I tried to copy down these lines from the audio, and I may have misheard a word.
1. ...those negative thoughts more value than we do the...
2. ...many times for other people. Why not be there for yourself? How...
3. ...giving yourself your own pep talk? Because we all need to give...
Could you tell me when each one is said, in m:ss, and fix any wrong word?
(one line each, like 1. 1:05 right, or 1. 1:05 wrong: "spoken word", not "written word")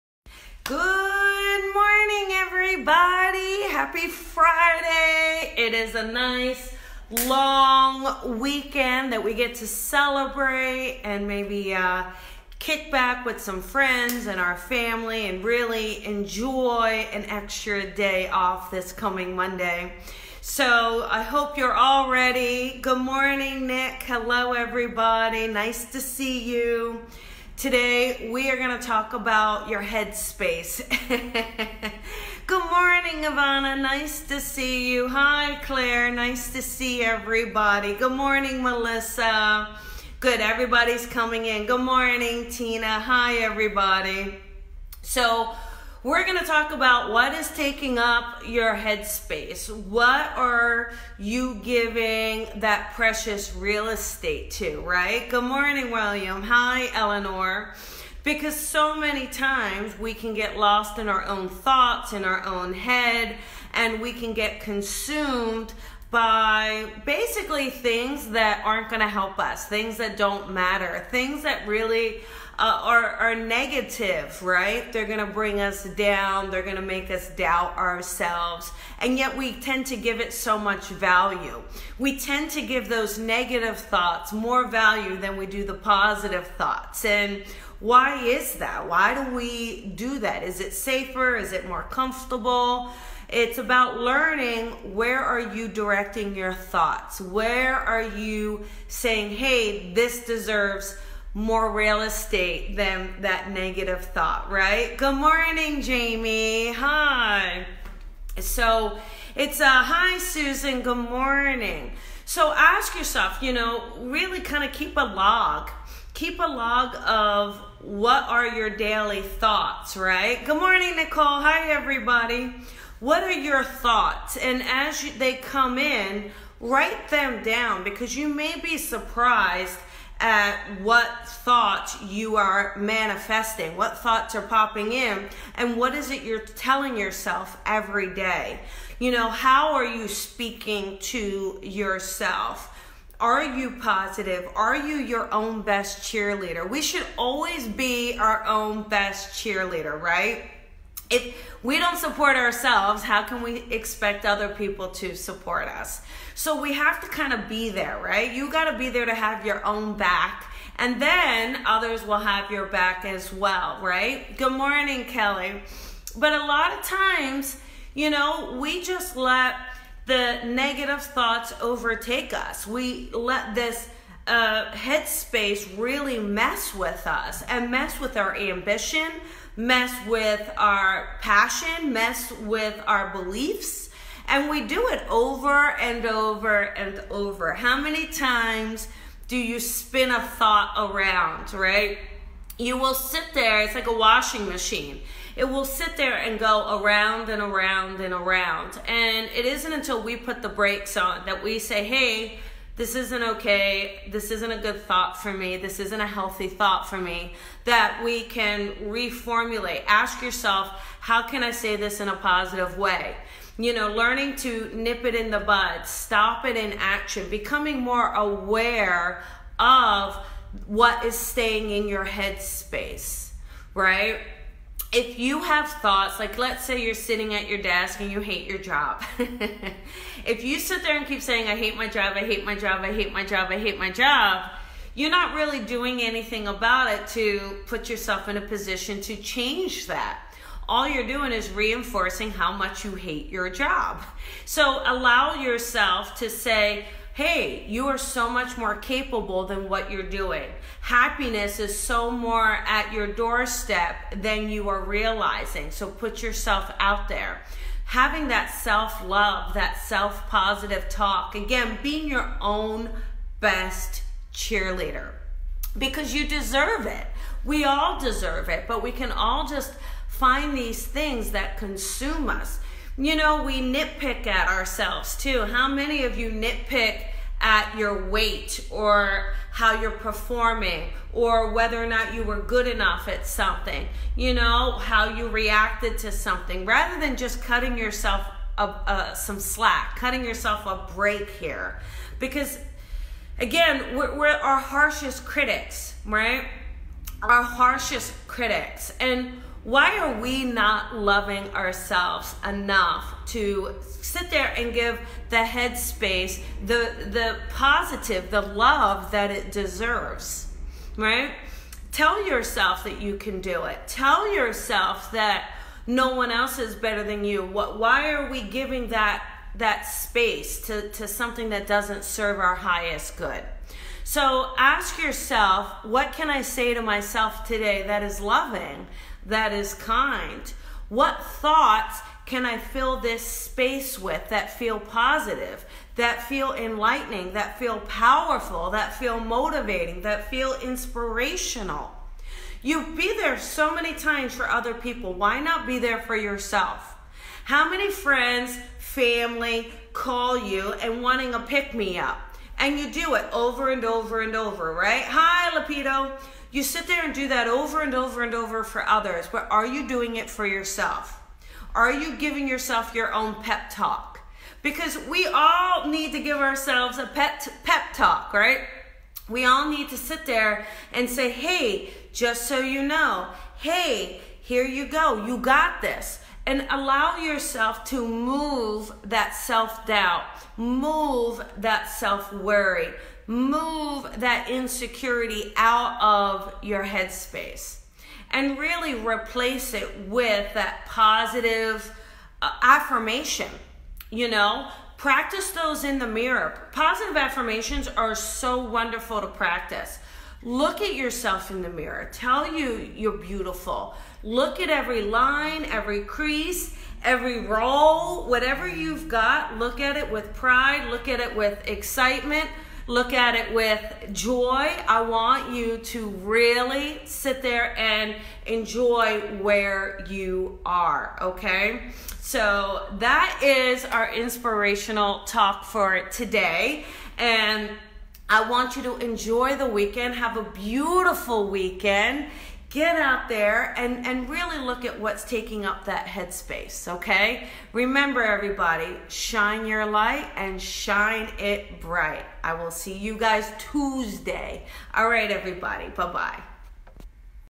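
1. 1:22 right
2. 5:43 right
3. 6:02 right.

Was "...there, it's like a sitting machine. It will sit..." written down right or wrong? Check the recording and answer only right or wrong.
wrong.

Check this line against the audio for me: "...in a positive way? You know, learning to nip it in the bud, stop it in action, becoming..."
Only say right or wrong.
right.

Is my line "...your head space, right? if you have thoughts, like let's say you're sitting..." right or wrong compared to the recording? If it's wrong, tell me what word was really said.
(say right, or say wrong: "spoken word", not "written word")
right.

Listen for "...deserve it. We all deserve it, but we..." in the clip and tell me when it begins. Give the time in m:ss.
4:26.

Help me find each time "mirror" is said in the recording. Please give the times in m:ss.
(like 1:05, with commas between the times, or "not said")
6:36, 6:41.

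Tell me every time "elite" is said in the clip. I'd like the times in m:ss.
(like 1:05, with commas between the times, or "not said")
not said.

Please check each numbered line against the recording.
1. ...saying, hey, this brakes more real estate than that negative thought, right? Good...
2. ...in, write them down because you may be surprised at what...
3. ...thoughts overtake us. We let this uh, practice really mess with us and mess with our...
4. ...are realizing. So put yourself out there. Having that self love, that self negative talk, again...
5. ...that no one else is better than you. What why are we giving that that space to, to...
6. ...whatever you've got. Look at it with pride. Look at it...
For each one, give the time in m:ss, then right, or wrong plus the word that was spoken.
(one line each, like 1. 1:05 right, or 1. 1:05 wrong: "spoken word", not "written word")
1. 1:38 wrong: "deserves", not "brakes"
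2. 2:05 right
3. 2:51 wrong: "headspace", not "practice"
4. 4:14 wrong: "positive", not "negative"
5. 5:15 right
6. 6:48 right.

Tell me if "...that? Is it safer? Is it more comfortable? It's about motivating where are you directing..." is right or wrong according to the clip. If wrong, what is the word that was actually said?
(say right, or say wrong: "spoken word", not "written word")
wrong: "learning", not "motivating".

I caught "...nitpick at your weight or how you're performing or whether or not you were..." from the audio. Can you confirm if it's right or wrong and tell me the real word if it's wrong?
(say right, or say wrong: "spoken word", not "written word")
right.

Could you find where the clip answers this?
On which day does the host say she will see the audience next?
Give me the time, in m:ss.
7:23.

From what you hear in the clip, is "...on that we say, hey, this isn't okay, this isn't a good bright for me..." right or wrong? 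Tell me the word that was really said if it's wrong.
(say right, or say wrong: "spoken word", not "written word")
wrong: "thought", not "bright".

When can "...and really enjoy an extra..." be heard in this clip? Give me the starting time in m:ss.
0:15.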